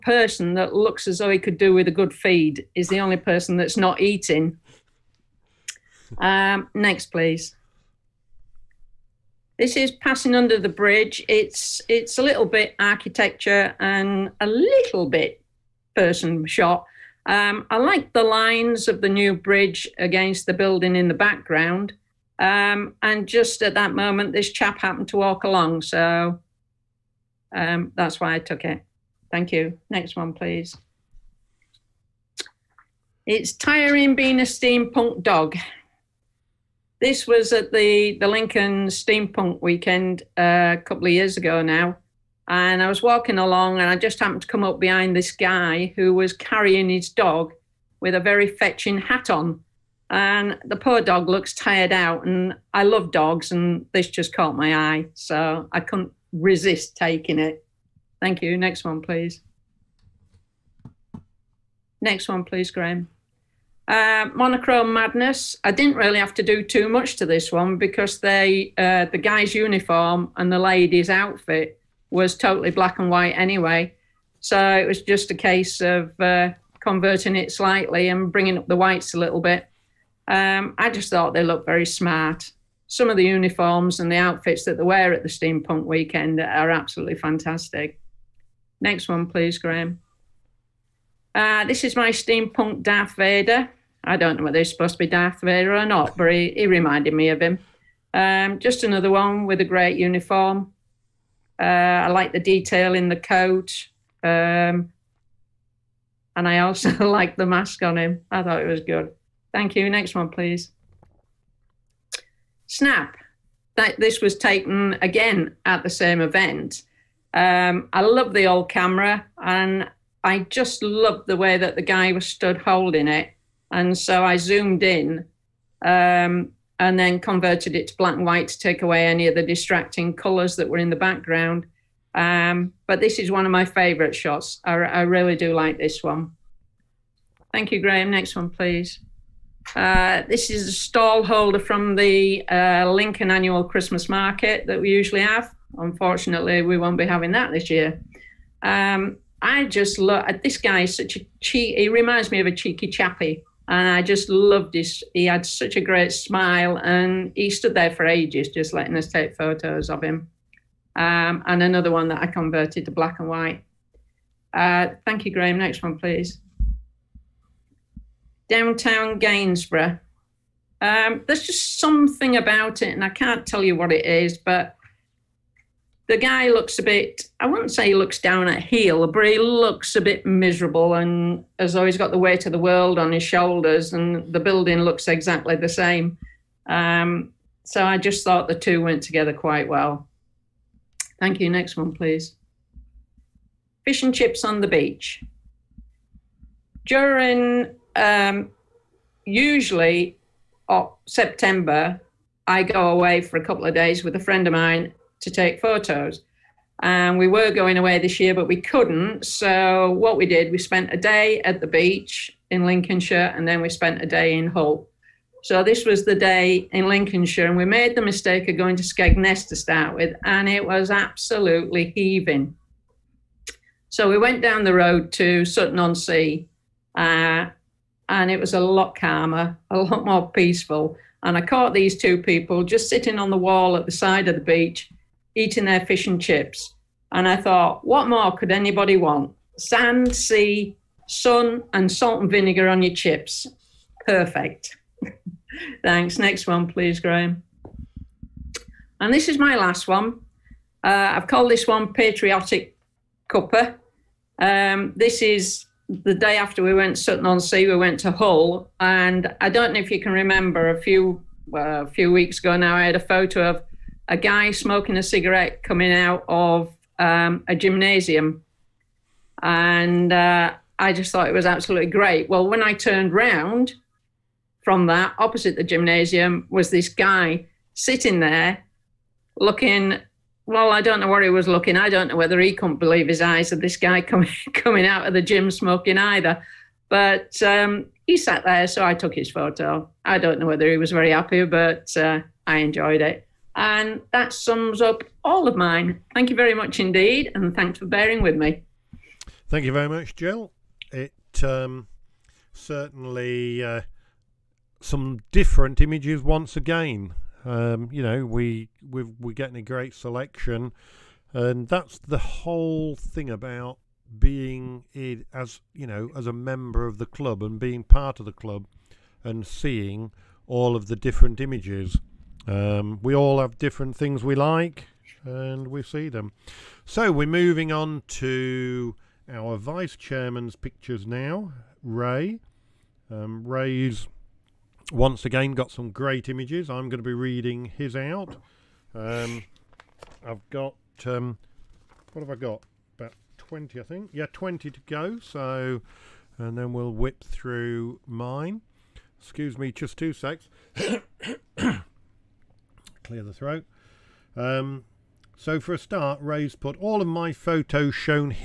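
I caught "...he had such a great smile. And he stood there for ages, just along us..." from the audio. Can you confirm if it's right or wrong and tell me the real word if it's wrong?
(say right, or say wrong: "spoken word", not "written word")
wrong: "letting", not "along".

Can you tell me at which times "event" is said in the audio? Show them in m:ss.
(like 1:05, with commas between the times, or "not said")
1:56.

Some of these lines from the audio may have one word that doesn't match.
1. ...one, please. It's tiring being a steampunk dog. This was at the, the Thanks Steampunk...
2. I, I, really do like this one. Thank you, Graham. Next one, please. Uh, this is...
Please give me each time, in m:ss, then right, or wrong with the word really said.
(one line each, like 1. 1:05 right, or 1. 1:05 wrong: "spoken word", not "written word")
1. 0:30 wrong: "Lincoln", not "Thanks"
2. 2:14 right.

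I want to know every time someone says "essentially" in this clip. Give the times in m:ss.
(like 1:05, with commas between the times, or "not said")
not said.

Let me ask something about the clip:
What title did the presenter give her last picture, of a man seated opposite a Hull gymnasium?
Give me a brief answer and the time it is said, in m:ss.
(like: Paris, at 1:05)
Patriotic Cuppa, at 4:11.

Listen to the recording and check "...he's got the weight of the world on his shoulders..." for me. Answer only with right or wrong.
right.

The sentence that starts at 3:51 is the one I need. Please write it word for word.
And I caught these two people just sitting on the wall at the side of the beach, eating their fish and chips.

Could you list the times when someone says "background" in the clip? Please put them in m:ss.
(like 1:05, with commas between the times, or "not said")
0:21, 2:10.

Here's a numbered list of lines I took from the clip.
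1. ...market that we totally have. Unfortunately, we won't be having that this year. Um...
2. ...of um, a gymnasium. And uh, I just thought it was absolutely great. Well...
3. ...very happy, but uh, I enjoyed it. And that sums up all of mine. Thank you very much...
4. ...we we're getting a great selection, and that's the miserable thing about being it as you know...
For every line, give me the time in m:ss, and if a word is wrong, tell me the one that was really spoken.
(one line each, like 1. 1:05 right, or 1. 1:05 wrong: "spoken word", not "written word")
1. 2:24 wrong: "usually", not "totally"
2. 4:26 right
3. 4:50 right
4. 5:08 wrong: "whole", not "miserable".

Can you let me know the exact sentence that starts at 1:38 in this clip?
Um, just another one with a great uniform.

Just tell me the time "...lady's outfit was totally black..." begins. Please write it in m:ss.
1:10.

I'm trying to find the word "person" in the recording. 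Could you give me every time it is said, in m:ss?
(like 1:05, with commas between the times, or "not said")
0:03, 0:15.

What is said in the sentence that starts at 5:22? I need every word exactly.
Um, we all have different things we like, and we see them.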